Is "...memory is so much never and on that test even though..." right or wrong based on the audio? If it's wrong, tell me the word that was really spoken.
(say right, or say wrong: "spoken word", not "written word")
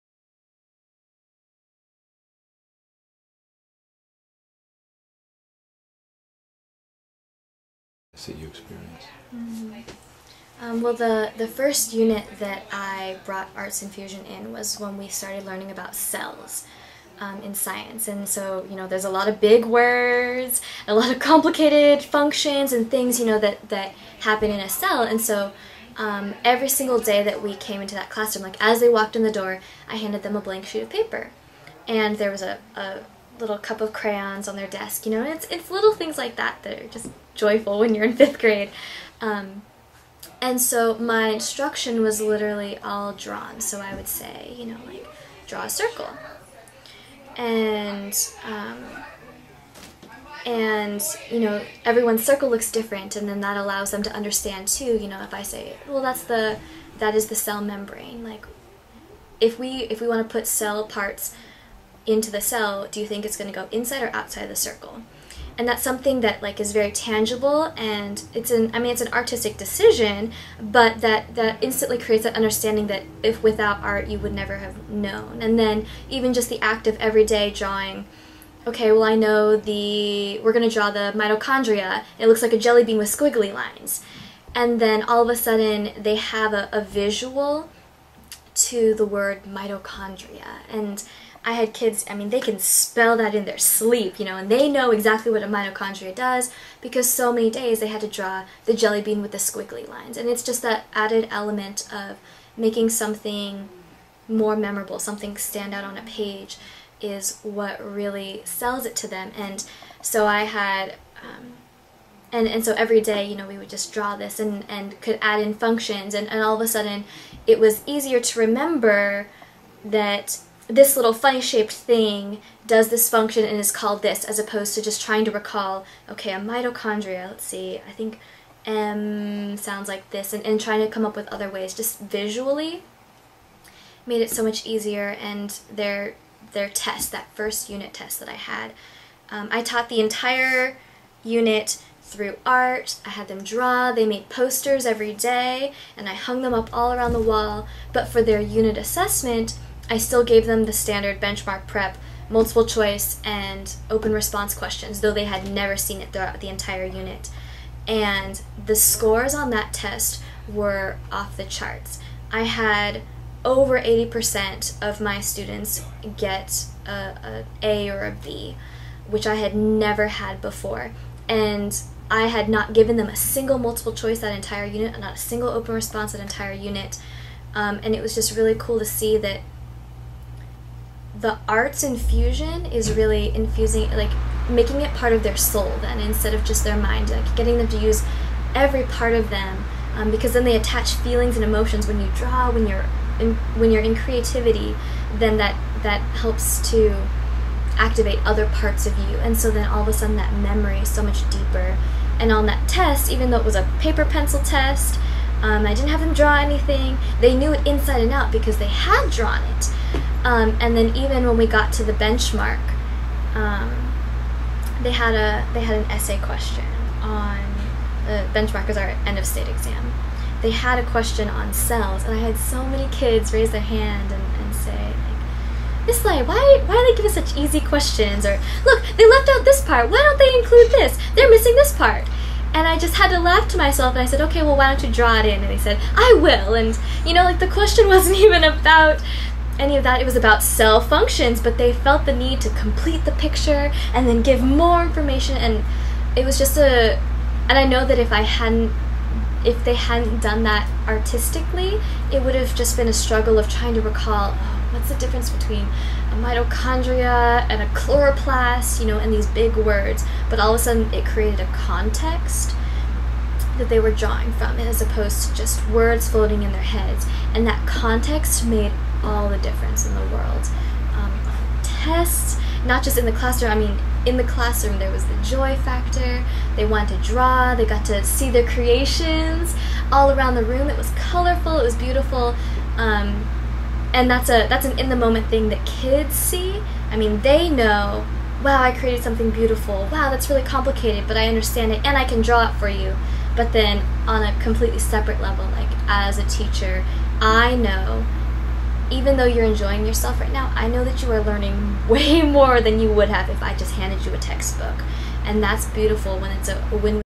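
wrong: "deeper", not "never".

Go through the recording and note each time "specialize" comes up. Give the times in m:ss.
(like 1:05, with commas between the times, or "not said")
not said.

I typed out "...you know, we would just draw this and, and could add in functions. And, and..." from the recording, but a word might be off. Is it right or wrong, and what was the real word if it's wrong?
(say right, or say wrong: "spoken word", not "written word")
right.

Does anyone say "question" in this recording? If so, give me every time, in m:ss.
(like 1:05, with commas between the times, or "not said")
2:34, 3:36, 3:40, 3:47, 3:57.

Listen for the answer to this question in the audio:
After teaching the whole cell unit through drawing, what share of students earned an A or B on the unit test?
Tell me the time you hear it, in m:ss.
2:43.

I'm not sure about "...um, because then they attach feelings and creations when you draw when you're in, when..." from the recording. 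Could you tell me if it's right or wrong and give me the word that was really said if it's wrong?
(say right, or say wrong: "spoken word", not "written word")
wrong: "emotions", not "creations".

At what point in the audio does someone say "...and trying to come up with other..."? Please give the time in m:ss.
2:10.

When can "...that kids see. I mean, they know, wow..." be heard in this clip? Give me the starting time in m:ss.
4:45.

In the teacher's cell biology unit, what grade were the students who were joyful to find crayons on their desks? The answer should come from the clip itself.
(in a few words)
Fifth grade.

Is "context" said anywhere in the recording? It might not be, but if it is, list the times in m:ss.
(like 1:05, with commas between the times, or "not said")
4:21, 4:27.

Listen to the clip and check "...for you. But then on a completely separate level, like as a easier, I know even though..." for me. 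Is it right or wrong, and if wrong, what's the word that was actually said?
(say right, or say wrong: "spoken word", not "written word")
wrong: "teacher", not "easier".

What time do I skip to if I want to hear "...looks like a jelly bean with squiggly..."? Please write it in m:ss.
1:22.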